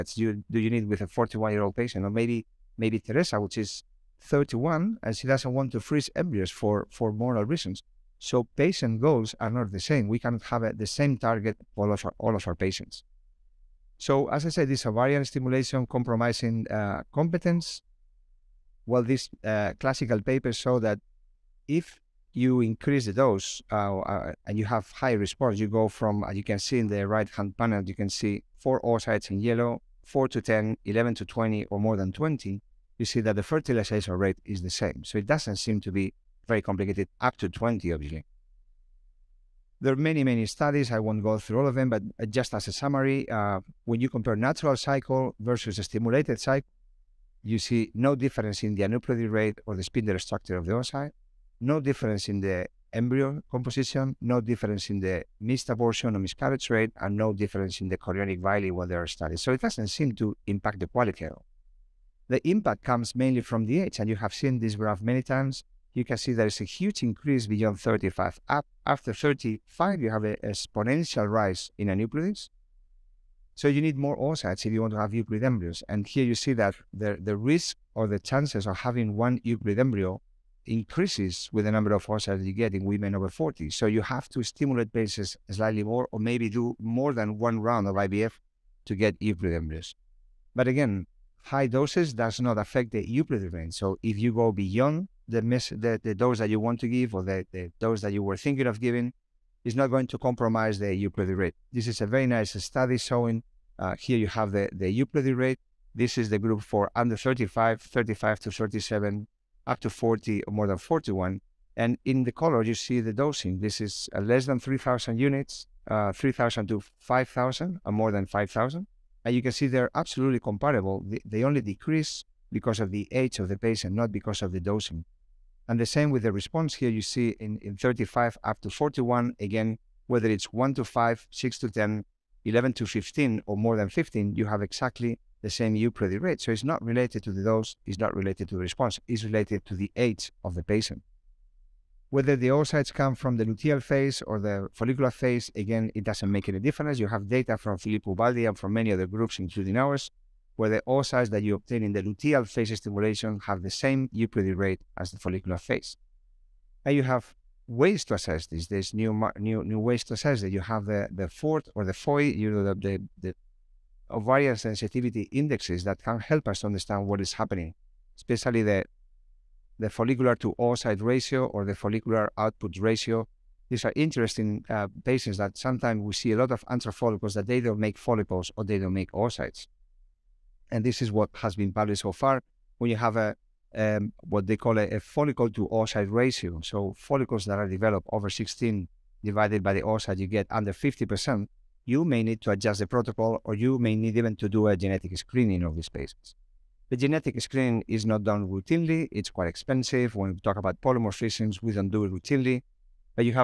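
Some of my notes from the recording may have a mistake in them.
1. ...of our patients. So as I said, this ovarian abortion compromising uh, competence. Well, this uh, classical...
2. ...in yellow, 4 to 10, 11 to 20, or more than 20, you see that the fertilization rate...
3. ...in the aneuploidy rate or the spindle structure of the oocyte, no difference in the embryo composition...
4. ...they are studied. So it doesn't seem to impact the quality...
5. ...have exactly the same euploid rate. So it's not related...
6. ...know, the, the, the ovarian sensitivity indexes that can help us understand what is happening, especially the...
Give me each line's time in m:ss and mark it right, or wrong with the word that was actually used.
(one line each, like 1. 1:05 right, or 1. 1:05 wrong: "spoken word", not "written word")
1. 0:12 wrong: "stimulation", not "abortion"
2. 0:29 right
3. 0:48 right
4. 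0:58 right
5. 2:14 right
6. 2:42 right.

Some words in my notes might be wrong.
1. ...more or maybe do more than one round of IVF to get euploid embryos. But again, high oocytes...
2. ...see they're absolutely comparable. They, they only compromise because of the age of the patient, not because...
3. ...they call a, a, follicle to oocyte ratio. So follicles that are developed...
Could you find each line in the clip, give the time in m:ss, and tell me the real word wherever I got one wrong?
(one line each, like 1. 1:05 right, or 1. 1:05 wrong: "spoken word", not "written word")
1. 1:25 wrong: "doses", not "oocytes"
2. 1:59 wrong: "decrease", not "compromise"
3. 3:04 right.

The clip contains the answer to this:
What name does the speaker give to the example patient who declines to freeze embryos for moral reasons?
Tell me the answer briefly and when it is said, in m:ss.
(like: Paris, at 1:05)
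Teresa, at 0:02.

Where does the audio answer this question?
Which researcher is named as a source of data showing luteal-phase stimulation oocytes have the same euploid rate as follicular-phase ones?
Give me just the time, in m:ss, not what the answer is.
2:27.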